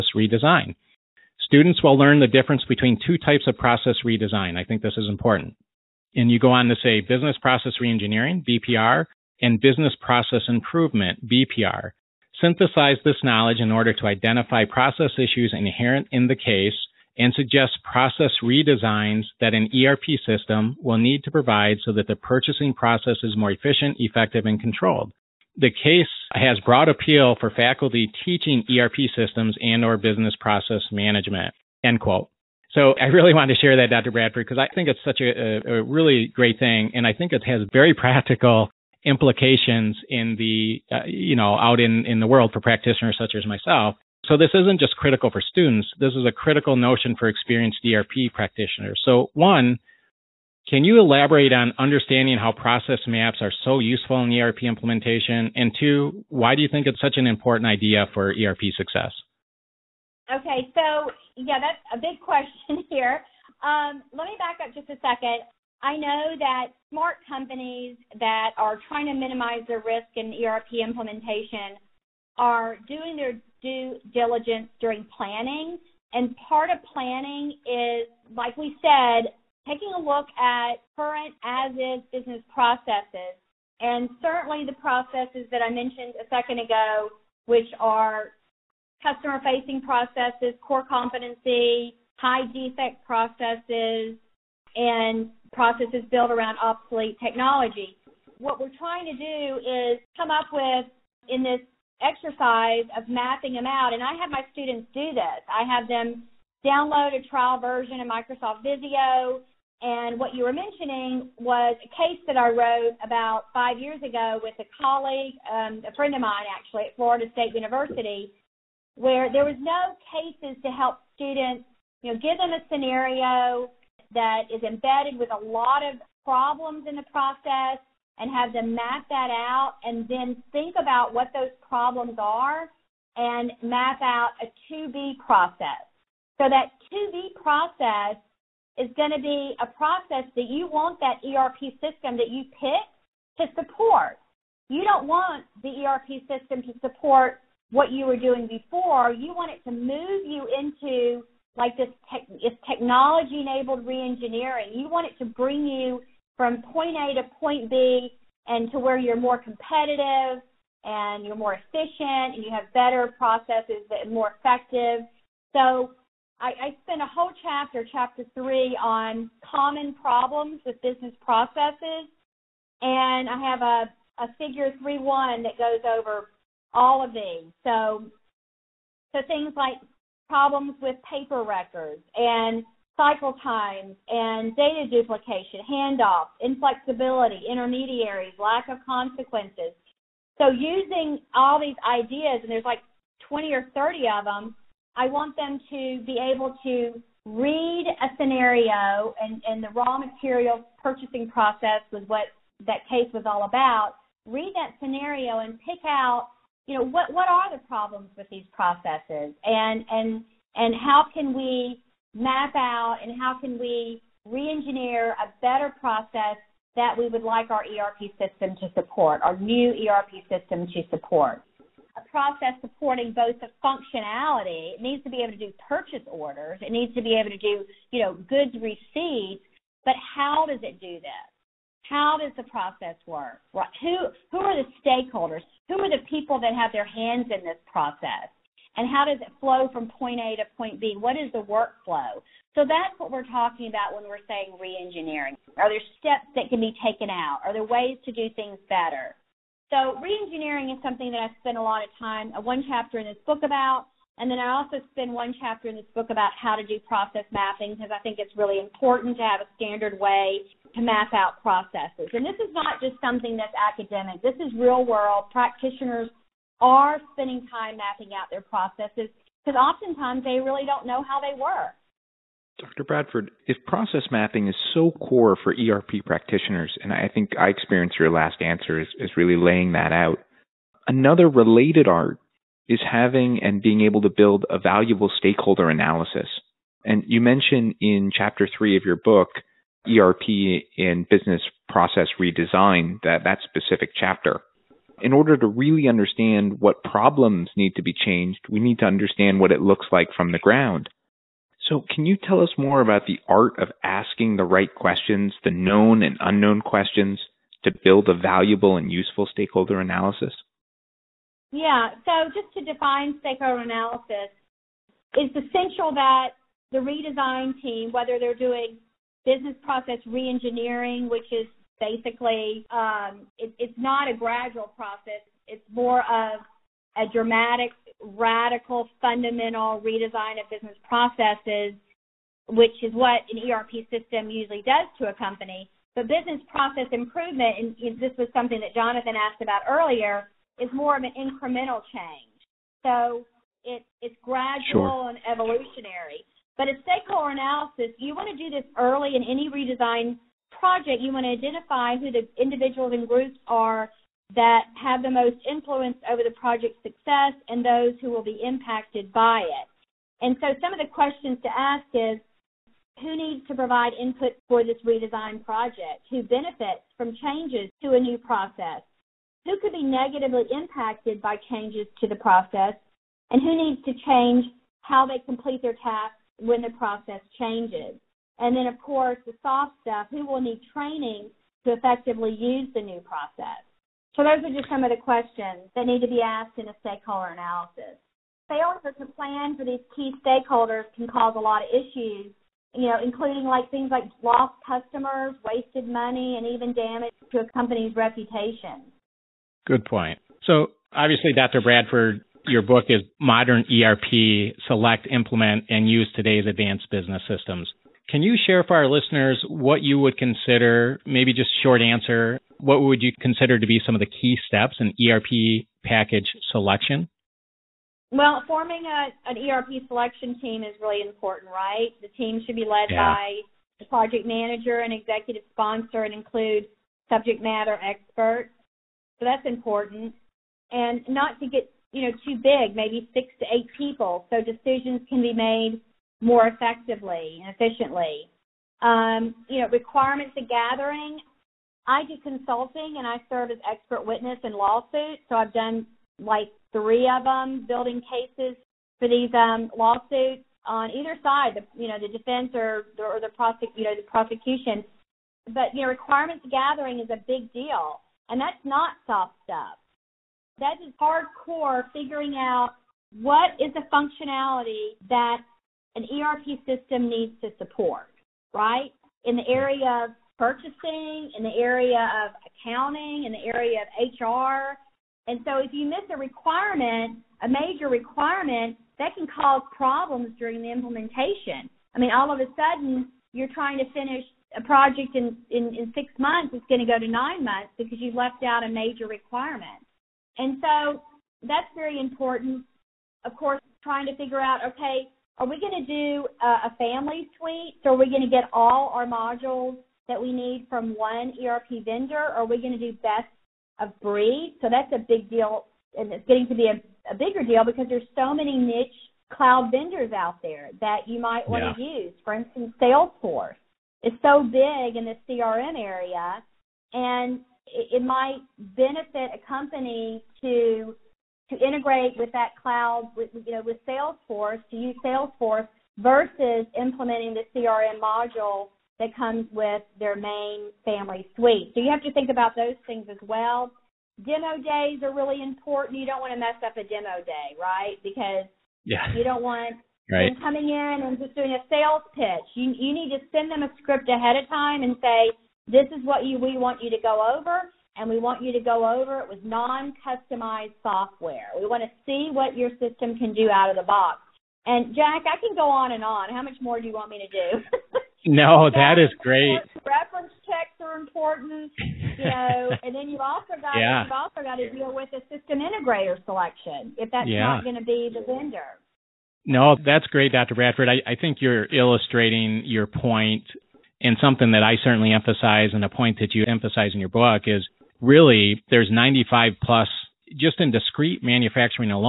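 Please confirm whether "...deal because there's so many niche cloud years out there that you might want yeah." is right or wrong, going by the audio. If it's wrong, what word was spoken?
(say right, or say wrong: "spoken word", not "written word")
wrong: "vendors", not "years".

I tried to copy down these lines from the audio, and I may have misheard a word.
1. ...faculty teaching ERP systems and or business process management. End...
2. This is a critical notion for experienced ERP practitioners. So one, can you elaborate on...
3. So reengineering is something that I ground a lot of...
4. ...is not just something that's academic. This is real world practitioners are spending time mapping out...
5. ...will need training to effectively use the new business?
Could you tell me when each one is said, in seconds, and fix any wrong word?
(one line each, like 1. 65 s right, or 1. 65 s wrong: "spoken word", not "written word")
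1. 27 s right
2. 45 s right
3. 249 s wrong: "spend", not "ground"
4. 262 s right
5. 380 s wrong: "process", not "business".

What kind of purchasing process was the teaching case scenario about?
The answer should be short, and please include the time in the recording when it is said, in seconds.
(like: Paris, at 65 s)
Raw material purchasing, at 199 s.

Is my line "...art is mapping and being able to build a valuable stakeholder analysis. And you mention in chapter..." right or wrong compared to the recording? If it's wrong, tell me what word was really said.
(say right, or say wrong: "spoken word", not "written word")
wrong: "having", not "mapping".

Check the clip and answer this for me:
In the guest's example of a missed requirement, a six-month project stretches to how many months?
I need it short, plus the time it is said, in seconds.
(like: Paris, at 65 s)
9 months, at 487 s.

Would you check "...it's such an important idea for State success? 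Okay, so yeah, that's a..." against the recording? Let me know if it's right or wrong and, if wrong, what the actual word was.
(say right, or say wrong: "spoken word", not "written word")
wrong: "ERP", not "State".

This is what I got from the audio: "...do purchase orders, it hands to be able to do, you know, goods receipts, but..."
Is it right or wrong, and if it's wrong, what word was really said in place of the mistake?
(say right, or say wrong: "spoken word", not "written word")
wrong: "needs", not "hands".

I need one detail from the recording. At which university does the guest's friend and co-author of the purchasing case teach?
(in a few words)
Florida State University.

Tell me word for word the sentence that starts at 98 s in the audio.
What we're trying to do is come up with in this exercise of mapping them out.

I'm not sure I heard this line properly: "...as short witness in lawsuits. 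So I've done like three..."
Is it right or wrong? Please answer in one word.
wrong.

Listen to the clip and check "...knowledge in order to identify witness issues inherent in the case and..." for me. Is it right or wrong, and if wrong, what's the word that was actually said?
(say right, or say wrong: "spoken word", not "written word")
wrong: "process", not "witness".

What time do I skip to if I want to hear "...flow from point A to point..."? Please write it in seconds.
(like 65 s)
239 s.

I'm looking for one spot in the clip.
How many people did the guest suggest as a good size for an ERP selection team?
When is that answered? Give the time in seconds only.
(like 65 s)
433 s.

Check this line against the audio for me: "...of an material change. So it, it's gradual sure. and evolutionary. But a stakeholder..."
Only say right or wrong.
wrong.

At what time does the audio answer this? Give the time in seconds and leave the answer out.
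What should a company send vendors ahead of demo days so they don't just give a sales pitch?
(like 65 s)
543 s.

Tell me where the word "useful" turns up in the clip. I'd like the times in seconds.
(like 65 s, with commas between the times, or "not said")
53 s, 308 s.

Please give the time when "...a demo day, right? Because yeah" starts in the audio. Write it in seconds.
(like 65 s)
536 s.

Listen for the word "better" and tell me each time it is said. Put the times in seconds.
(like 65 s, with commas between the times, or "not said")
162 s, 215 s, 248 s.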